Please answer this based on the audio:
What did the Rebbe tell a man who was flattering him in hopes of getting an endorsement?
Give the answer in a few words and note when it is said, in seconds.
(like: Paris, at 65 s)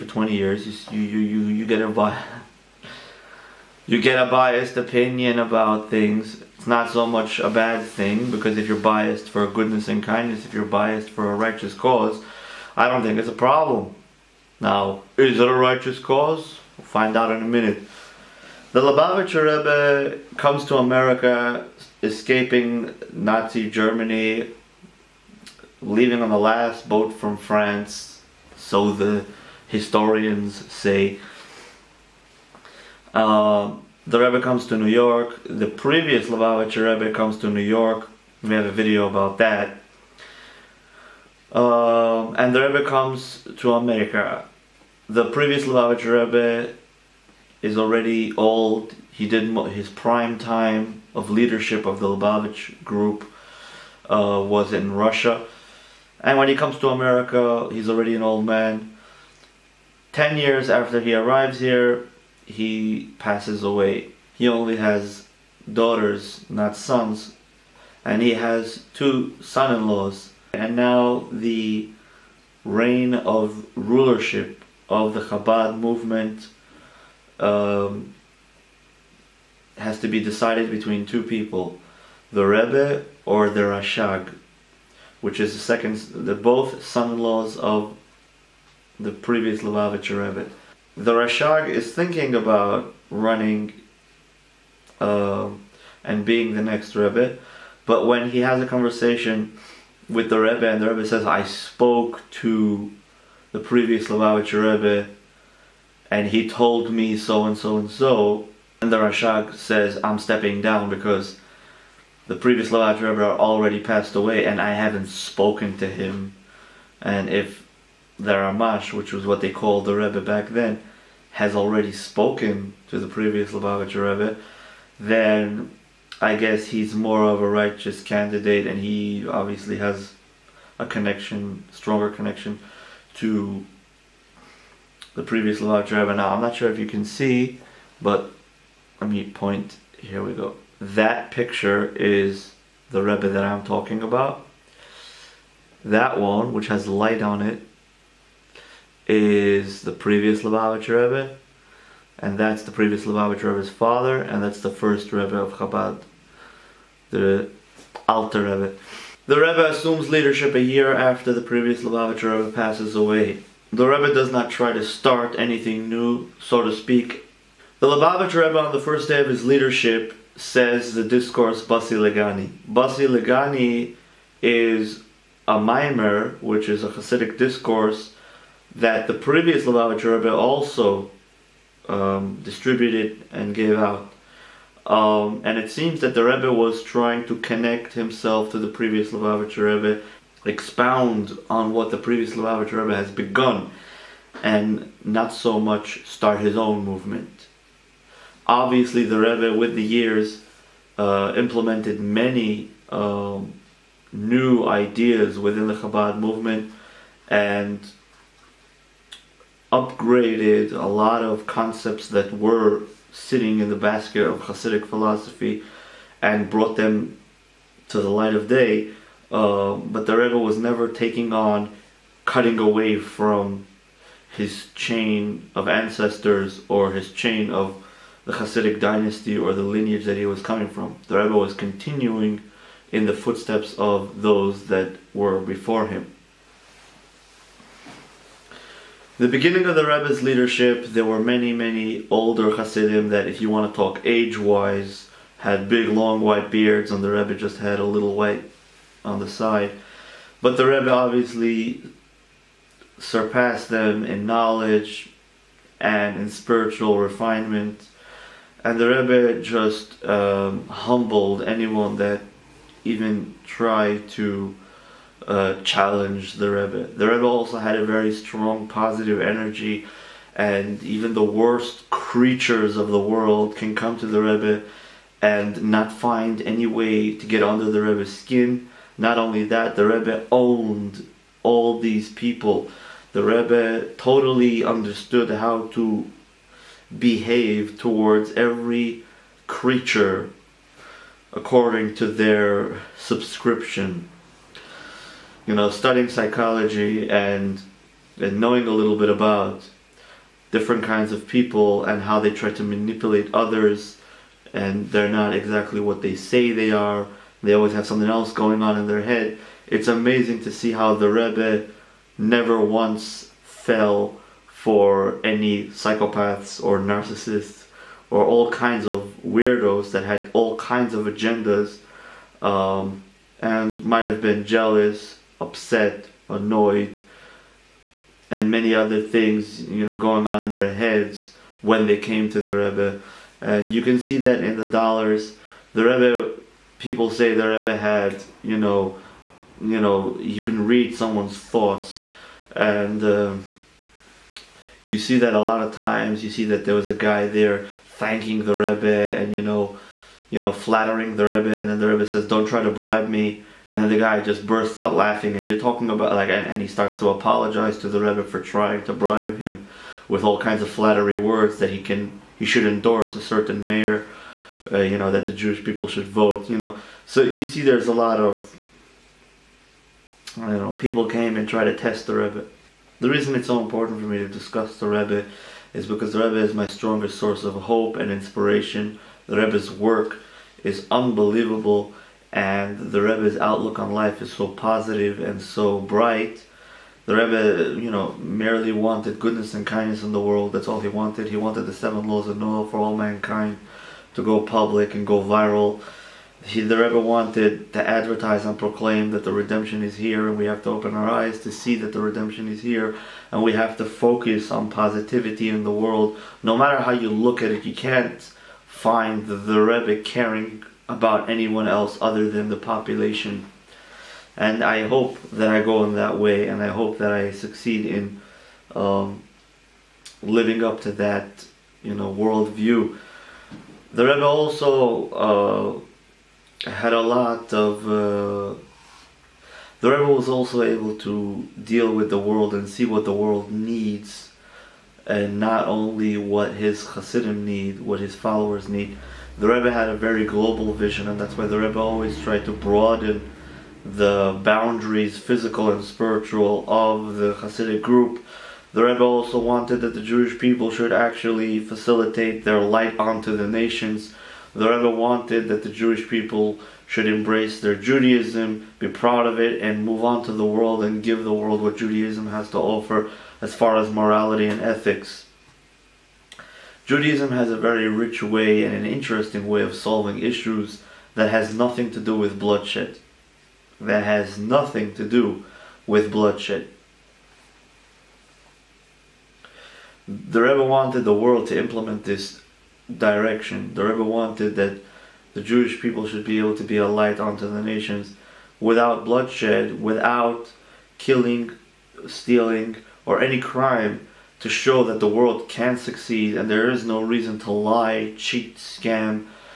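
Don't try to bribe me, at 352 s.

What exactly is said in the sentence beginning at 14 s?
Now, is it a righteous cause?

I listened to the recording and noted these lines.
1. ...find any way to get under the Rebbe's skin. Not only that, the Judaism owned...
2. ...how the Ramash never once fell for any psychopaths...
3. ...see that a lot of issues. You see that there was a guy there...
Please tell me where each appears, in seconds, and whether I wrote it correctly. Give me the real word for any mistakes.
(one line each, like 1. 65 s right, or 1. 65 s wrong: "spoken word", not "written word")
1. 275 s wrong: "Rebbe", not "Judaism"
2. 310 s wrong: "Rebbe", not "Ramash"
3. 344 s wrong: "times", not "issues".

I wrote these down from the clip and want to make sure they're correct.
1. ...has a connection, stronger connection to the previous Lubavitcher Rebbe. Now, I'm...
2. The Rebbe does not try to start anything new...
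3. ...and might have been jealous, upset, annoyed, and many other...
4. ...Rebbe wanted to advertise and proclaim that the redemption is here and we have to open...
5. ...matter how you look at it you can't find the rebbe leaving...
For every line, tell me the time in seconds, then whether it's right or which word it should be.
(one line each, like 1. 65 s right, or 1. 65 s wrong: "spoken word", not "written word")
1. 129 s right
2. 163 s right
3. 323 s right
4. 396 s right
5. 406 s wrong: "caring", not "leaving".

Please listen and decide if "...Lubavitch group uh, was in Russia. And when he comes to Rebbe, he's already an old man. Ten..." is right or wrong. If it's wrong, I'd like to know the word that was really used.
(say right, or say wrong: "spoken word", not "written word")
wrong: "America", not "Rebbe".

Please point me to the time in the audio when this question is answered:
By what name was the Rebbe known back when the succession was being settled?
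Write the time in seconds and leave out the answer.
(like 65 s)
118 s.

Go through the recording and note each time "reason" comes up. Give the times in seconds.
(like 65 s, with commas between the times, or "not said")
373 s, 497 s.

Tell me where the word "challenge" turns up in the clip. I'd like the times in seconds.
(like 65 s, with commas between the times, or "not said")
265 s.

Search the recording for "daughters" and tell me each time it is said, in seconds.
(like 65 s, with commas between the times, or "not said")
65 s.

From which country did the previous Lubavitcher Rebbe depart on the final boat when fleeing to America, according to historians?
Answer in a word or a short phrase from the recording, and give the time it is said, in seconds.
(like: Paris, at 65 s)
France, at 27 s.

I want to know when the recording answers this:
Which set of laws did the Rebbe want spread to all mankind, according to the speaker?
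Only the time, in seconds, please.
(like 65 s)
391 s.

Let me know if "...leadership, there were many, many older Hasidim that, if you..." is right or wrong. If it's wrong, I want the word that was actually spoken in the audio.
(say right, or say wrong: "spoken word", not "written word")
right.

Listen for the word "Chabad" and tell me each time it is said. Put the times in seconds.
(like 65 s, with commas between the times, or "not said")
75 s, 155 s, 205 s.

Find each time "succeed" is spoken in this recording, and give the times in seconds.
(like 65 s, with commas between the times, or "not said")
417 s, 495 s.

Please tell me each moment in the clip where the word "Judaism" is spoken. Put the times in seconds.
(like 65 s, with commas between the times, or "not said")
457 s, 461 s, 466 s.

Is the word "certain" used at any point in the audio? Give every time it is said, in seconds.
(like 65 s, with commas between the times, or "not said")
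363 s.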